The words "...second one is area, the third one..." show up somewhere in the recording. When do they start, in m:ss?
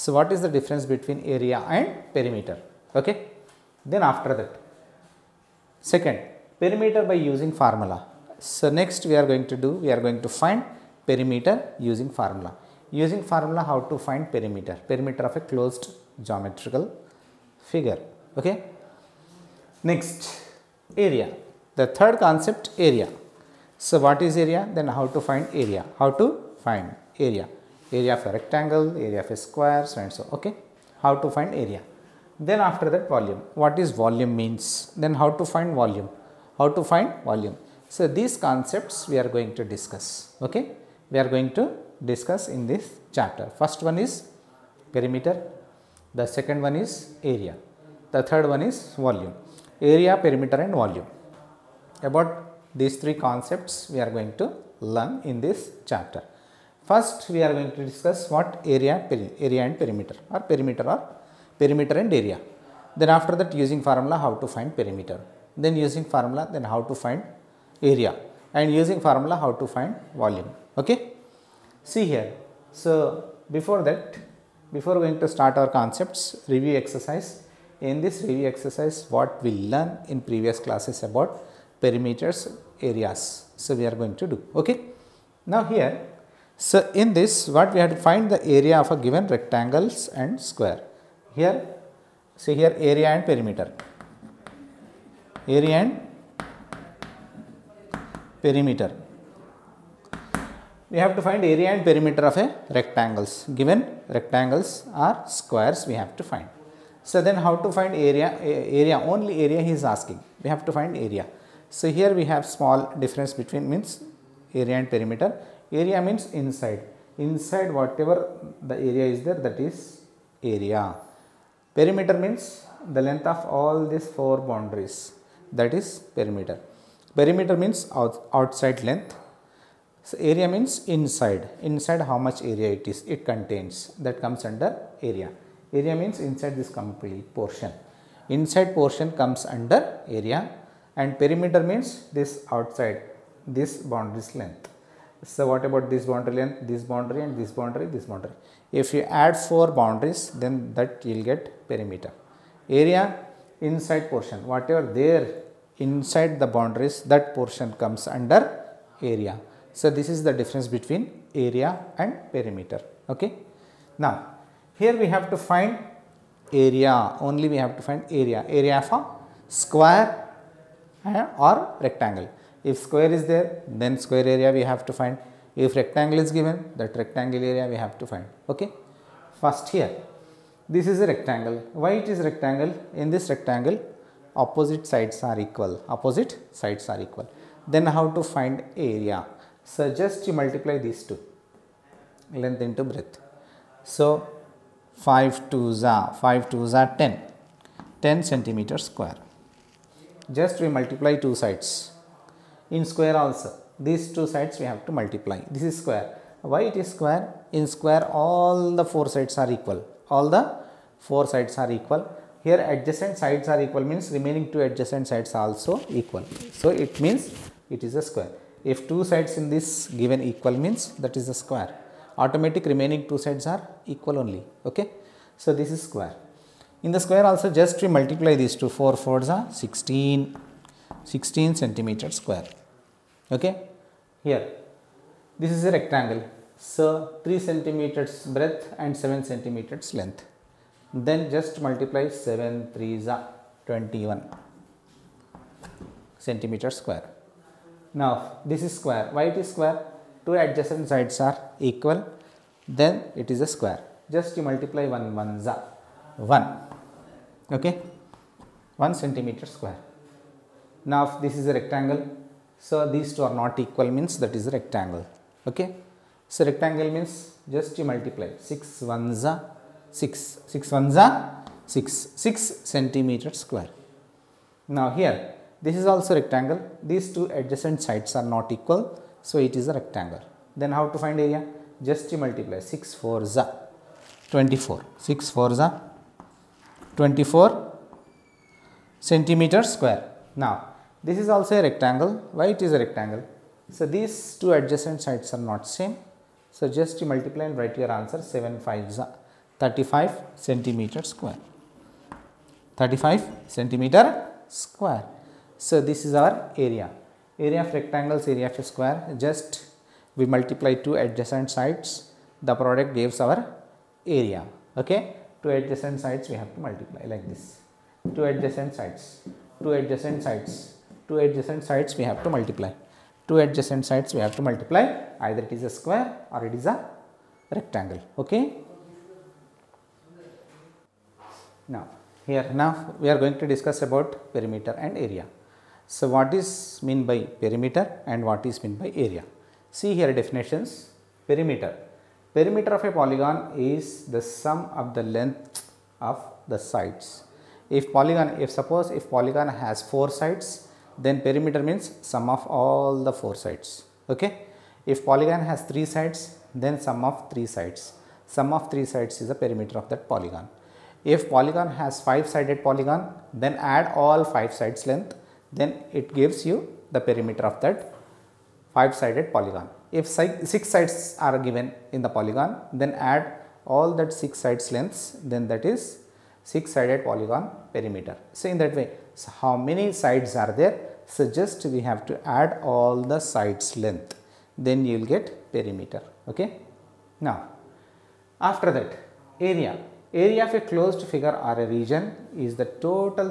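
0:46.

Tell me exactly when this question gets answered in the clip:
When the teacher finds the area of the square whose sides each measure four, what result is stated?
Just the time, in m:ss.
3:51.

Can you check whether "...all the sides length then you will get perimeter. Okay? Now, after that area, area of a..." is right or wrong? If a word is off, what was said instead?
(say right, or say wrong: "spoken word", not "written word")
right.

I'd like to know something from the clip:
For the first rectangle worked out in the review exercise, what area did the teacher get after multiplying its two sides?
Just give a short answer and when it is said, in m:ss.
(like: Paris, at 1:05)
10 square centimeters, at 3:18.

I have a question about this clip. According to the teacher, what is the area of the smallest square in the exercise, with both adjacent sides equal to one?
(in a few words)
1 square centimeter.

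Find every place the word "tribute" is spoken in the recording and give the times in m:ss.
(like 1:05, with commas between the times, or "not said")
not said.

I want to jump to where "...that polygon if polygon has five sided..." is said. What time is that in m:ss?
5:59.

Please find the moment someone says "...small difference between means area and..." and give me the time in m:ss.
1:52.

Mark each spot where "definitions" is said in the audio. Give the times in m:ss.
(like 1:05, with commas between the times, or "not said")
5:40.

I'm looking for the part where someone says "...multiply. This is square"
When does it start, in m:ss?
3:24.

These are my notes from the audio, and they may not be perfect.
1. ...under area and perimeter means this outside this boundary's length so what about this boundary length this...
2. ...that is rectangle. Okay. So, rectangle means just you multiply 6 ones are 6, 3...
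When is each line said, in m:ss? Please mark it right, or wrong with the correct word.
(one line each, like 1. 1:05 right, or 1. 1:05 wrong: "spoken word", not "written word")
1. 2:19 right
2. 4:24 wrong: "6", not "3".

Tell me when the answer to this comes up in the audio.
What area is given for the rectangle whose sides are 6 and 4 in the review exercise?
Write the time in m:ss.
4:46.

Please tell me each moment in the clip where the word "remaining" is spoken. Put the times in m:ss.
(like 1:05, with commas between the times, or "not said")
3:34, 3:42.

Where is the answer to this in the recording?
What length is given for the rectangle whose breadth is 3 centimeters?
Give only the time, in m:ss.
3:59.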